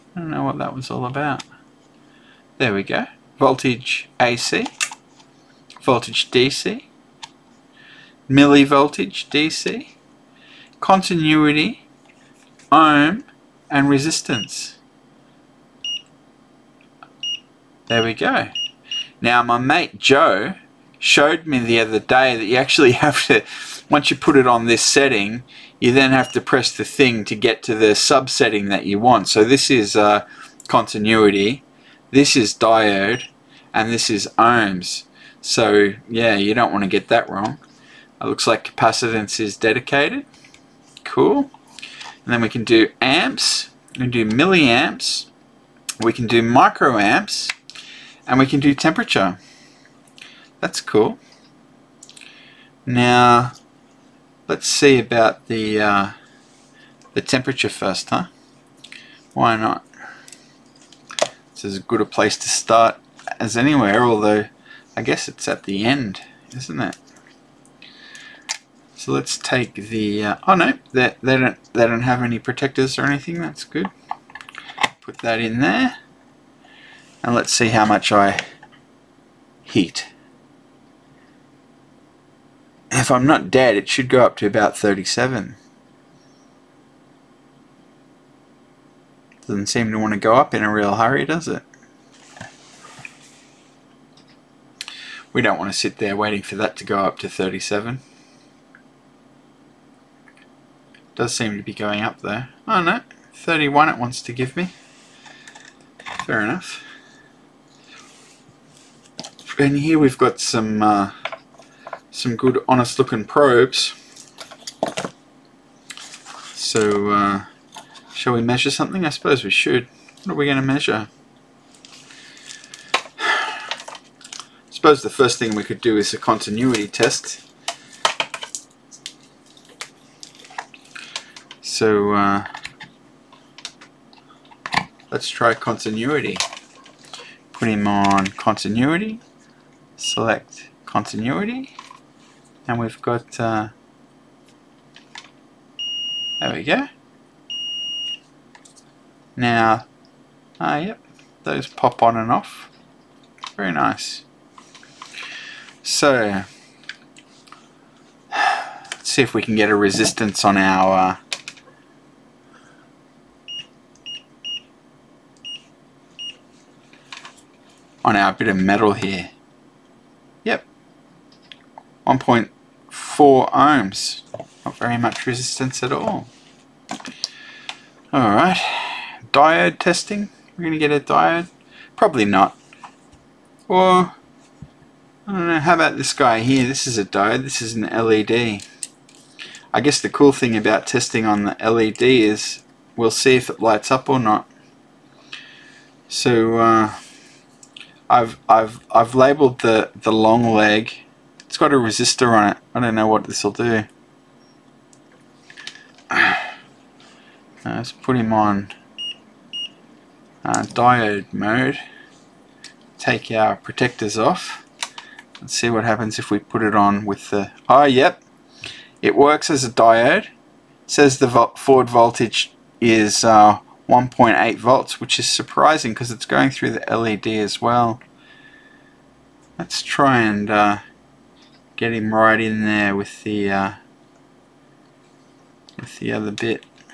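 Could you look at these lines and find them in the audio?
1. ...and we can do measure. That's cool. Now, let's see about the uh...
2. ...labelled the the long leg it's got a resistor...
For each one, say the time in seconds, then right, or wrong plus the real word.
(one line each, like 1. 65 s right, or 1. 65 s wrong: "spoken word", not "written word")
1. 48 s wrong: "temperature", not "measure"
2. 199 s right.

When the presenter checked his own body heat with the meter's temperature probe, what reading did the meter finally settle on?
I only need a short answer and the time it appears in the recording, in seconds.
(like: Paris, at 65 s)
31, at 103 s.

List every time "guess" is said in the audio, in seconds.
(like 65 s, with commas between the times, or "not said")
65 s, 189 s.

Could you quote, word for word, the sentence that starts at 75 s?
Put that in there, and let's see how much I heat if I'm not dead, it should go up to about 37.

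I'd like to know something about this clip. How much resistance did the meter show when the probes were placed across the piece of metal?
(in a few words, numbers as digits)
1.04 ohms.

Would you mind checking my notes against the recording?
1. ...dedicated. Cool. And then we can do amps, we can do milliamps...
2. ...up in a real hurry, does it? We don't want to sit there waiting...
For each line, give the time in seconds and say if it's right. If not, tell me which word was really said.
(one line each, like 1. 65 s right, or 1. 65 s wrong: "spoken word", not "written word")
1. 39 s right
2. 90 s right.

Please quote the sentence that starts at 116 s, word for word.
So uh, shall we measure something?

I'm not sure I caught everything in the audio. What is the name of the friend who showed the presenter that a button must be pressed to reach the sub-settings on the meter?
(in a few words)
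Joe.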